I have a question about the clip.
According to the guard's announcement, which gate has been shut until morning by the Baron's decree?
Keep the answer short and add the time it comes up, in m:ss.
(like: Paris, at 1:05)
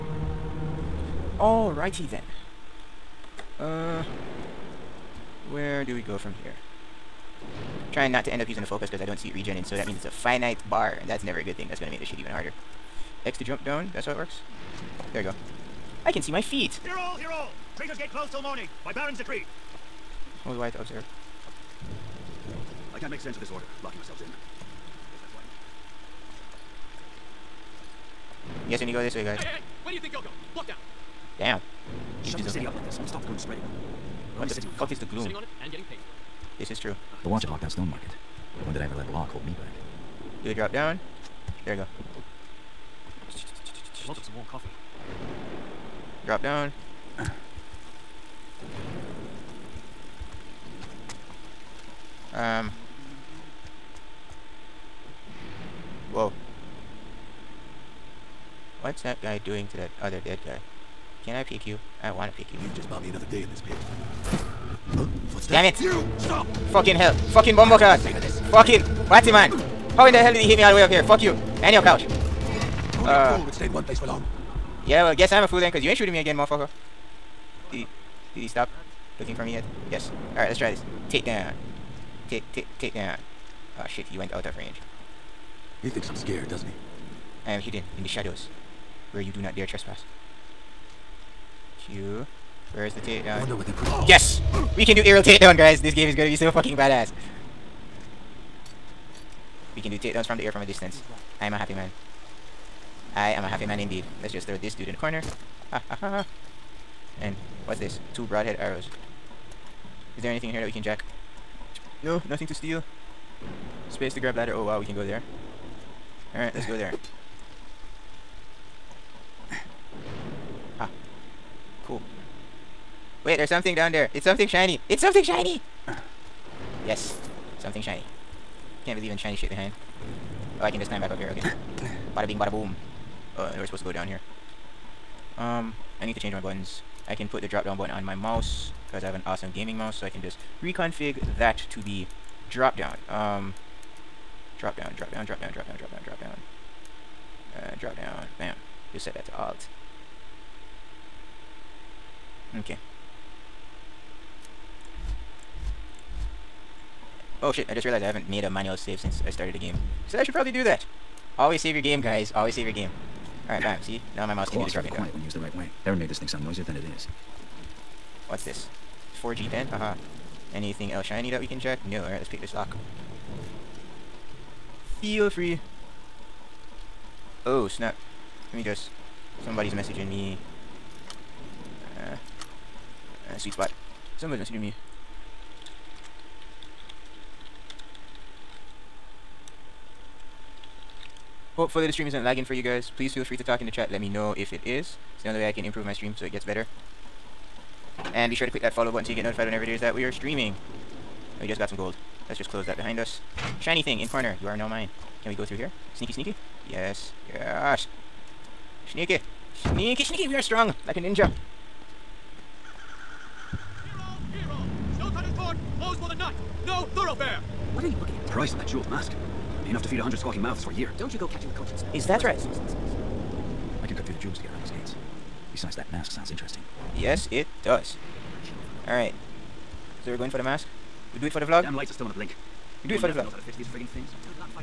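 Traitor's Gate, at 0:17.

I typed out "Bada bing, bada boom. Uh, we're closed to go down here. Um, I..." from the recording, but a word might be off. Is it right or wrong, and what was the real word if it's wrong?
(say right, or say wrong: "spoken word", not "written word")
wrong: "supposed", not "closed".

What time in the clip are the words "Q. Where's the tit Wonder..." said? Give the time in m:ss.
1:31.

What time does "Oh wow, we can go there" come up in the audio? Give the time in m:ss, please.
1:54.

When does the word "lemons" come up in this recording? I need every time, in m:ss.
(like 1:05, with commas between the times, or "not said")
not said.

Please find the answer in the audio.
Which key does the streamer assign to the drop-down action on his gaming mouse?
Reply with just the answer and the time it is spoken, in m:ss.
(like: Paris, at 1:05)
Alt, at 2:29.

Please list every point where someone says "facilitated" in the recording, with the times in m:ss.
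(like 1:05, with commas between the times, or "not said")
not said.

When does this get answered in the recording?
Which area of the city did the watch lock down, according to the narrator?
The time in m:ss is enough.
0:37.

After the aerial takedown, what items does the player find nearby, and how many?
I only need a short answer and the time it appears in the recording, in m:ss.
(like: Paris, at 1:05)
Two broadhead arrows, at 1:48.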